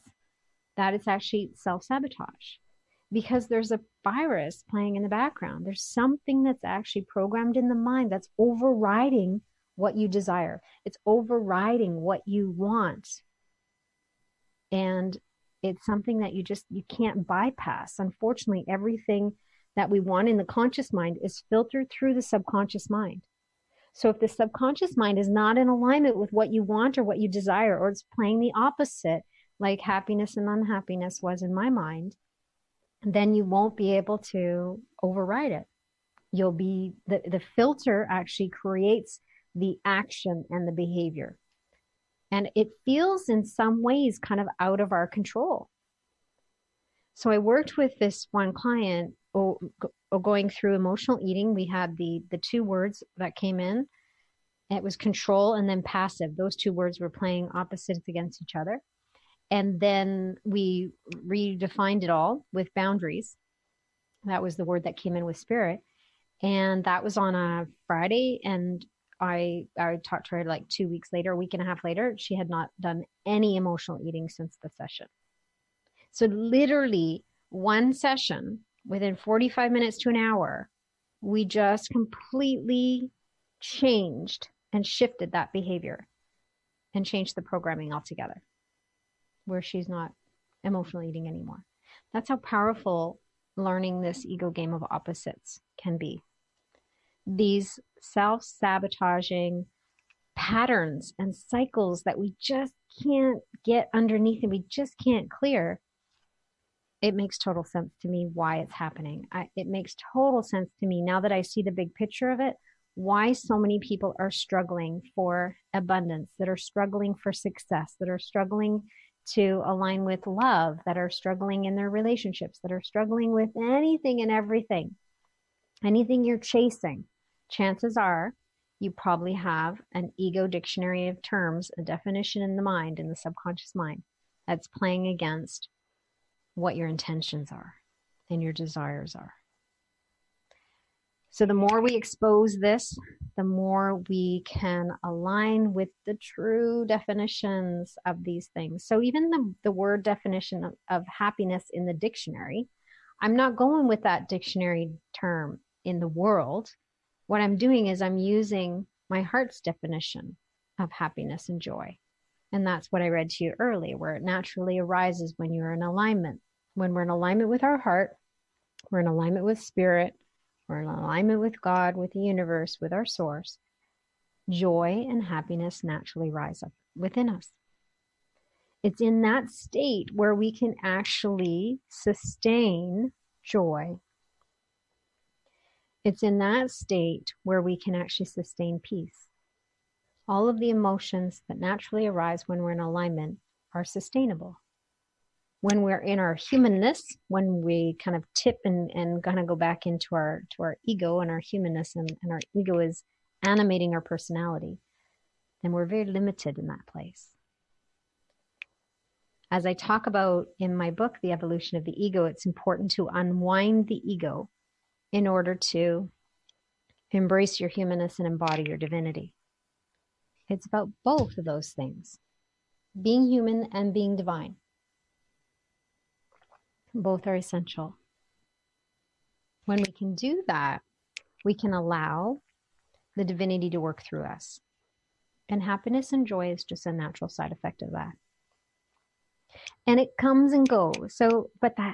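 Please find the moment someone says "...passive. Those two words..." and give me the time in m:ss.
0:55.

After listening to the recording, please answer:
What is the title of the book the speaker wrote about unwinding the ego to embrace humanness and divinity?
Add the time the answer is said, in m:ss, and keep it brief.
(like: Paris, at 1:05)
The Evolution of the Ego, at 3:31.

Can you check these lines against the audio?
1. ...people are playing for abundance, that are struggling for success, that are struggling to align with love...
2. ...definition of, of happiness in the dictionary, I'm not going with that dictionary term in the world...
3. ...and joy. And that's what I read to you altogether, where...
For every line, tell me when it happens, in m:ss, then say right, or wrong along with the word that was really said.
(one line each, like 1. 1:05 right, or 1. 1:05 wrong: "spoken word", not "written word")
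1. 1:53 wrong: "struggling", not "playing"
2. 2:30 right
3. 2:41 wrong: "earlier", not "altogether".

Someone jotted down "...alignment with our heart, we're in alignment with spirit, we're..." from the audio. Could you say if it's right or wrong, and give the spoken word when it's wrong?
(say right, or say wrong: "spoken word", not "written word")
right.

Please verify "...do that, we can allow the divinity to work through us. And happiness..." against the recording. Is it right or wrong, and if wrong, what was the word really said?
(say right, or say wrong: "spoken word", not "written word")
right.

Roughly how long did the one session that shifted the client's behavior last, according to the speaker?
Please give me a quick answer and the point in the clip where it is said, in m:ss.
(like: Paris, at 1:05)
45 minutes to an hour, at 1:19.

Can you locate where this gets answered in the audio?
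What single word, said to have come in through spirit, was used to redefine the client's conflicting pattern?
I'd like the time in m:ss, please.
1:02.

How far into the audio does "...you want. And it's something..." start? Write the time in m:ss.
0:12.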